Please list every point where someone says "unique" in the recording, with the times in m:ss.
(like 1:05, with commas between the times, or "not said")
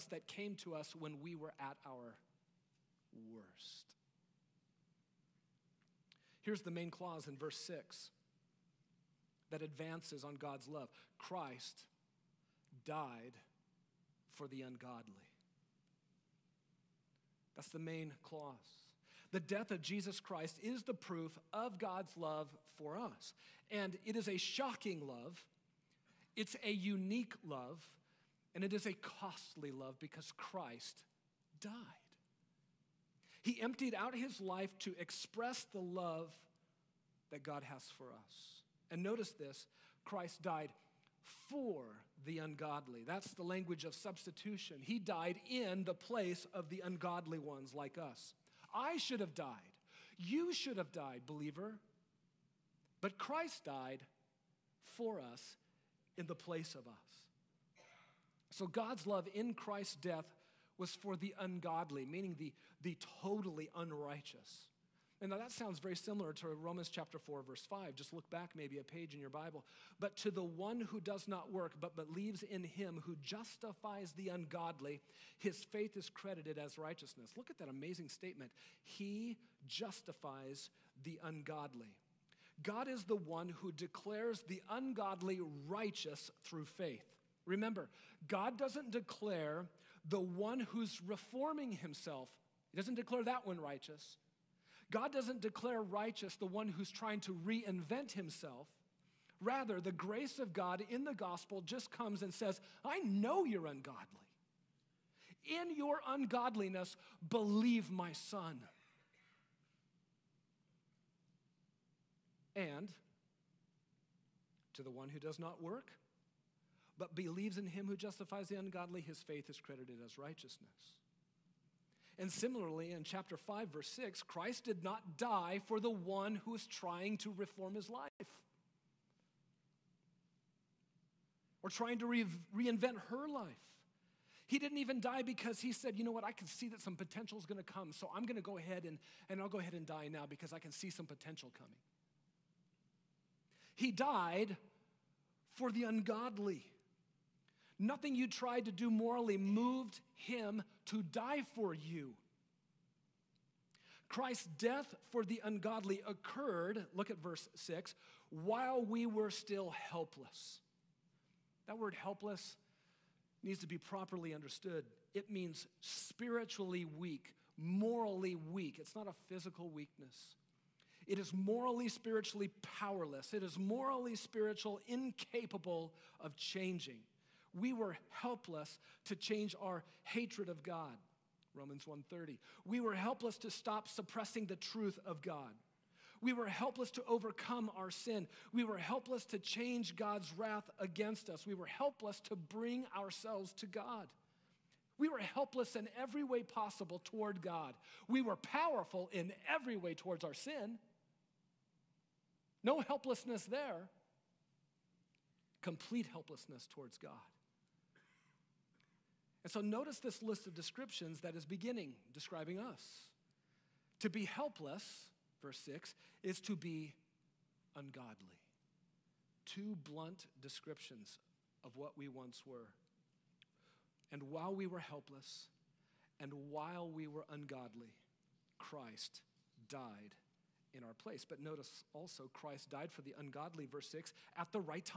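0:26.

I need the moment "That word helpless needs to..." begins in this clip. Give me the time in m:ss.
2:41.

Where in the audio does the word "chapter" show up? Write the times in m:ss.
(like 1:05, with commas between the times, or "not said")
1:06, 2:03.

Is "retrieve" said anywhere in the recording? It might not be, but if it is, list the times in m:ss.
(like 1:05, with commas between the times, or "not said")
not said.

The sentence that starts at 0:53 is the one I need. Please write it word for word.
But Christ died for us in the place of us.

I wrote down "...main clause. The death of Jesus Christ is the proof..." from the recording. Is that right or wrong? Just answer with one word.
right.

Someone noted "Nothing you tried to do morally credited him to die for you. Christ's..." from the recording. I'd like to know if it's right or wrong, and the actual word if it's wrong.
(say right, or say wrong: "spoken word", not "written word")
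wrong: "moved", not "credited".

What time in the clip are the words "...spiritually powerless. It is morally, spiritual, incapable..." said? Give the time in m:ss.
2:51.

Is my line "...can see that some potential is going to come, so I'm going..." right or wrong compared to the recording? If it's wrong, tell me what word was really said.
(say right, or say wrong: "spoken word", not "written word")
right.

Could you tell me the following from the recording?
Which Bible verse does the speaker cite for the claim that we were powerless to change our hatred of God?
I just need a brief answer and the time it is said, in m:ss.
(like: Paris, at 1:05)
Romans 1:30, at 3:01.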